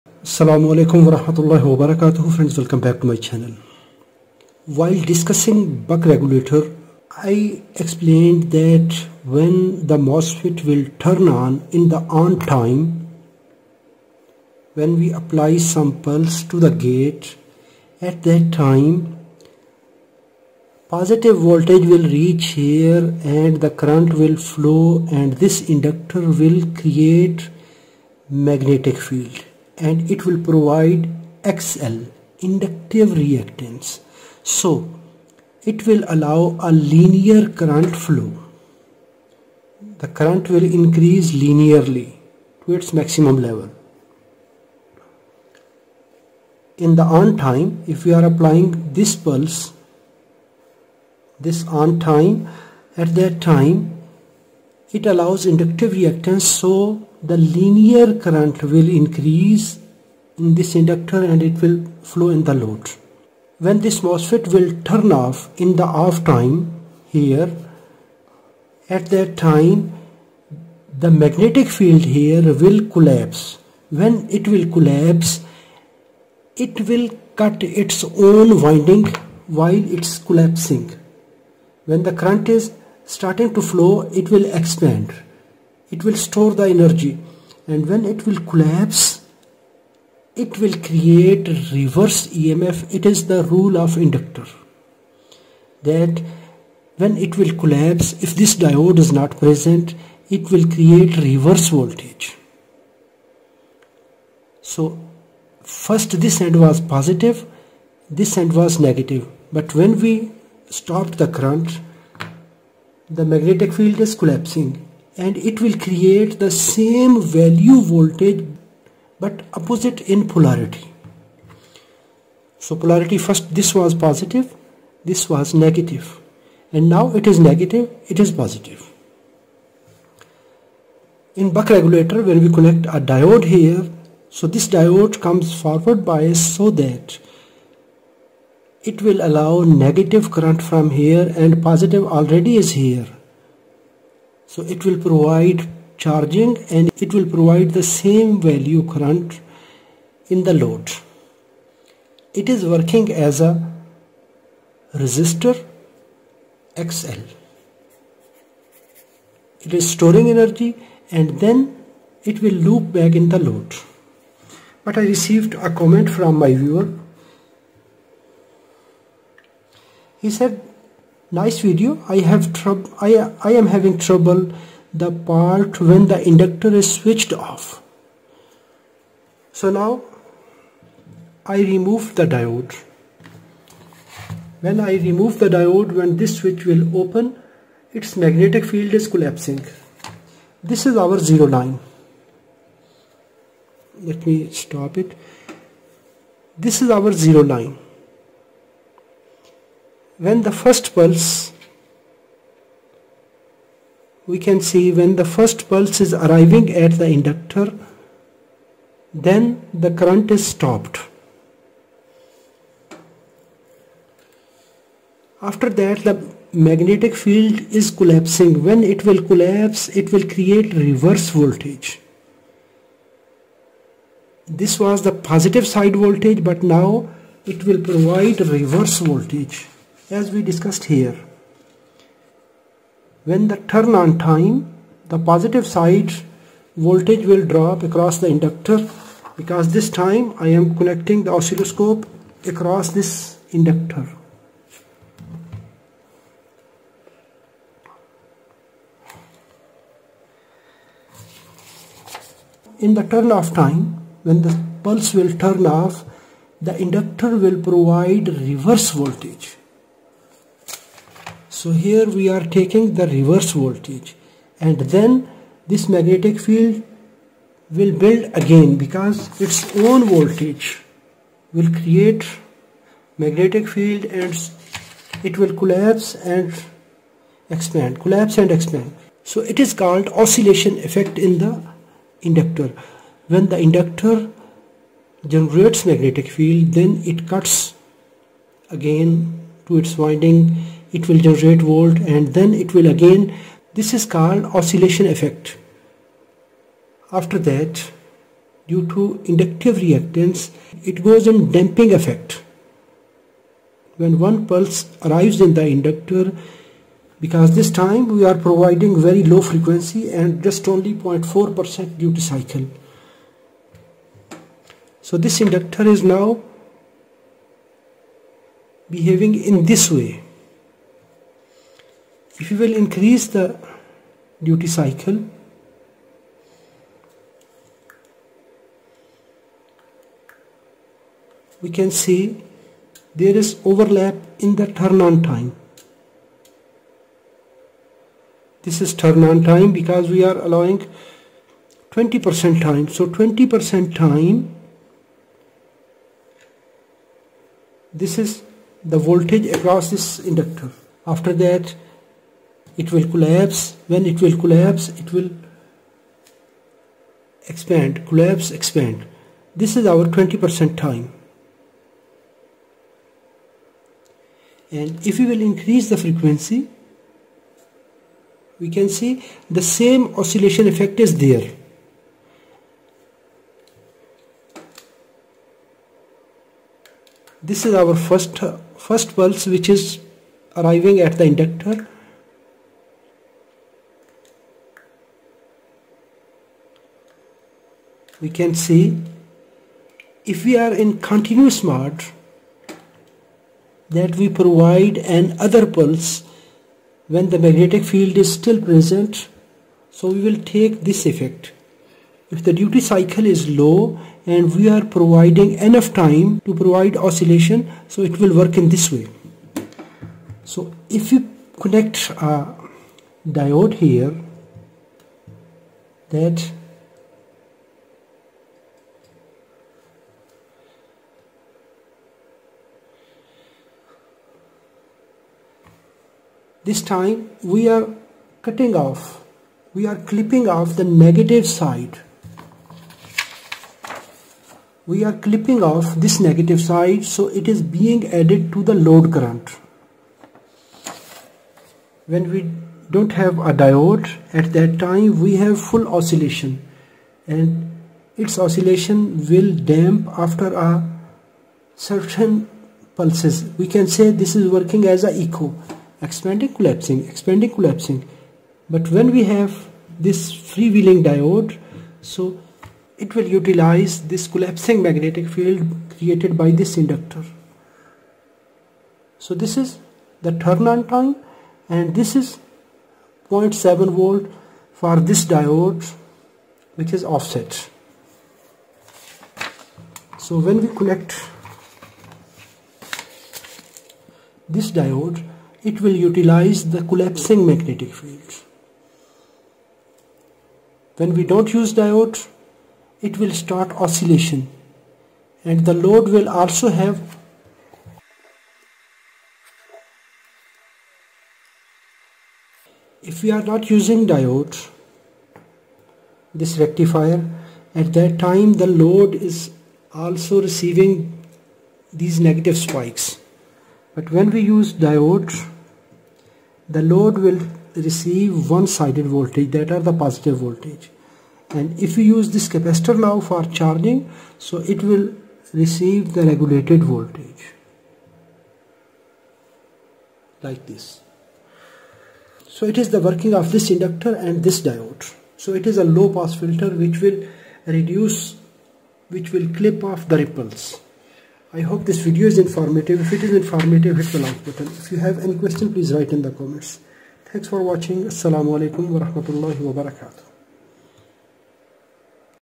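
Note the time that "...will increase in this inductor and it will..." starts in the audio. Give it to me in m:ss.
0:58.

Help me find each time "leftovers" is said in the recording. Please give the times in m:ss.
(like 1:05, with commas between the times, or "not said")
not said.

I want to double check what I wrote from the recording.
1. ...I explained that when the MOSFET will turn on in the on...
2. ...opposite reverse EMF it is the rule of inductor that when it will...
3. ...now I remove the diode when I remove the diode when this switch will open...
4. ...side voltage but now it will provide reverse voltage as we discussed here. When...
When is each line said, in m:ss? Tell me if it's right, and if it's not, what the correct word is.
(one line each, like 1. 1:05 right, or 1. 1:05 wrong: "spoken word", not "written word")
1. 0:07 right
2. 1:30 wrong: "create", not "opposite"
3. 2:59 right
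4. 3:45 right.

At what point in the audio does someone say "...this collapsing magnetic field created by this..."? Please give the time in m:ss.
7:44.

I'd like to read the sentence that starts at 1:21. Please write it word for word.
When the current is starting to flow, it will expand.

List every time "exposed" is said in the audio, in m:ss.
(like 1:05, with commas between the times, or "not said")
not said.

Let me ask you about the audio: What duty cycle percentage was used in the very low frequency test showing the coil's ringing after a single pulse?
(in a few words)
0.4%.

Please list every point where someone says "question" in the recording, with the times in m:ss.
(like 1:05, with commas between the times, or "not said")
9:05.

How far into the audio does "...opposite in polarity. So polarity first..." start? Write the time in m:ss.
1:59.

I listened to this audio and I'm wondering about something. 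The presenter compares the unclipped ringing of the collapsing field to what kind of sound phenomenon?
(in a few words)
Echo.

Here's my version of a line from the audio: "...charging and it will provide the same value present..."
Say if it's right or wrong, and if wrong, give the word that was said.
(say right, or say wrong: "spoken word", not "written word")
wrong: "current", not "present".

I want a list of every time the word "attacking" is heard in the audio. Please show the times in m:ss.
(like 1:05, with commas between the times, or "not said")
not said.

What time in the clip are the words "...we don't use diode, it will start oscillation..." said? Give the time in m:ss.
8:11.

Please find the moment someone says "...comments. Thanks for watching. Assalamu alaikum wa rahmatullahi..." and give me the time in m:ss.
9:06.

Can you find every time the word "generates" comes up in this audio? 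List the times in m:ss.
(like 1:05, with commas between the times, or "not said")
4:45, 4:51.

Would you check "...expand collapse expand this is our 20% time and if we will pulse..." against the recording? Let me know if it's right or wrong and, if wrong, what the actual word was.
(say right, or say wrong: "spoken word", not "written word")
wrong: "increase", not "pulse".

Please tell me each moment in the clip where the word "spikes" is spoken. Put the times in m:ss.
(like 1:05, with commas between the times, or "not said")
8:32.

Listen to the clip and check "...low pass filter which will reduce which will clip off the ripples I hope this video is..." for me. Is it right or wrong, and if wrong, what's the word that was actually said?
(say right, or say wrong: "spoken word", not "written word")
right.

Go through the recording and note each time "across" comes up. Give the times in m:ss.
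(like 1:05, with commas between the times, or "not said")
3:57, 4:02, 5:49.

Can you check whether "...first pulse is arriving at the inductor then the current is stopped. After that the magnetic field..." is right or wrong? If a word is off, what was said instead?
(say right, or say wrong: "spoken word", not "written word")
right.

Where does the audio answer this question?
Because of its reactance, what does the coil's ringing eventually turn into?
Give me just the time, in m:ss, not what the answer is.
5:01.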